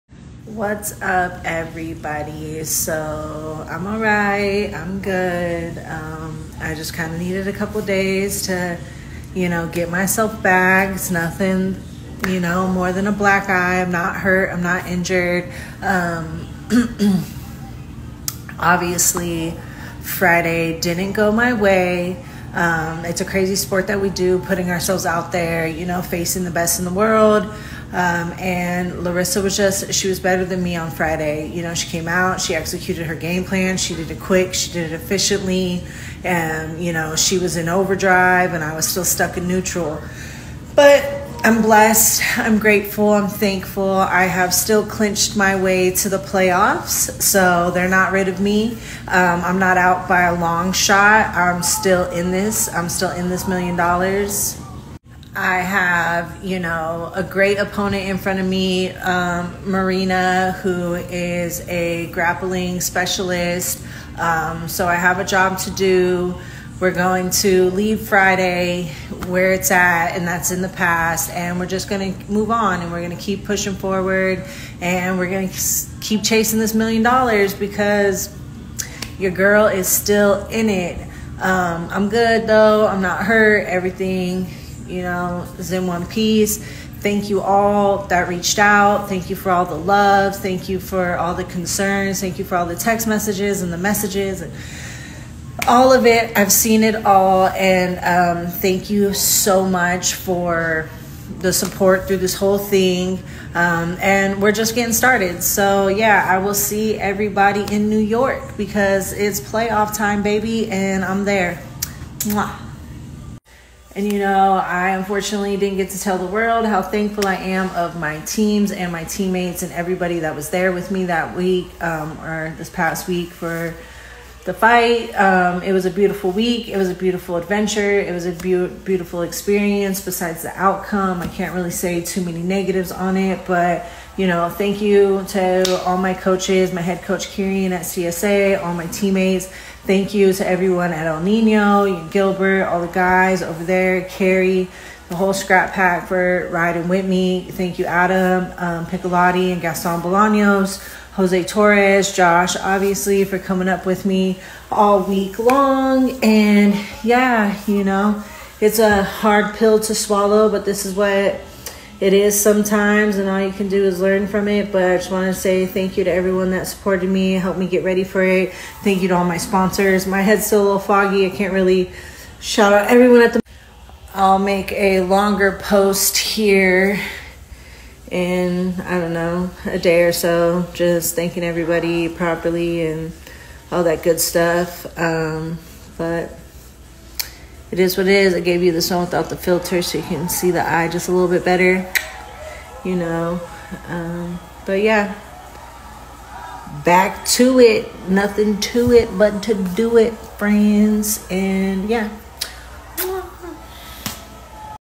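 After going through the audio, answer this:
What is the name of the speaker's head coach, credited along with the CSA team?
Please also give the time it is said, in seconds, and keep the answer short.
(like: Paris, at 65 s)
Kieran, at 137 s.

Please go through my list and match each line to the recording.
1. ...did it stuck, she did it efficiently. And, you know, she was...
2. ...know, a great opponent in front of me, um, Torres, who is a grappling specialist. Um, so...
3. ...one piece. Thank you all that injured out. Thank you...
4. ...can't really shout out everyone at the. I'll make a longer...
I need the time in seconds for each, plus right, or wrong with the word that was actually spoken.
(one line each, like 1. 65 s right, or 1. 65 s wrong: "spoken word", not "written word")
1. 33 s wrong: "quick", not "stuck"
2. 56 s wrong: "Marina", not "Torres"
3. 85 s wrong: "reached", not "injured"
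4. 171 s right.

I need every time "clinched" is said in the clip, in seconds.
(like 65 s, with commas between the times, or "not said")
44 s.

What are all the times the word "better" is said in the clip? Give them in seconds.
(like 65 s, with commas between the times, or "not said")
30 s, 191 s.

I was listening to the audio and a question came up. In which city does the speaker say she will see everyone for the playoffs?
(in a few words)
New York.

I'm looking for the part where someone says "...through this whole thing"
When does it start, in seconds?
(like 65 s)
102 s.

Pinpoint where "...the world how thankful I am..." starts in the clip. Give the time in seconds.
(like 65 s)
116 s.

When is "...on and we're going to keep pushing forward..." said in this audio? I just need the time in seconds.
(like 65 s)
72 s.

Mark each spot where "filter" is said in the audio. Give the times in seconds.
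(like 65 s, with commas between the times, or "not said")
189 s.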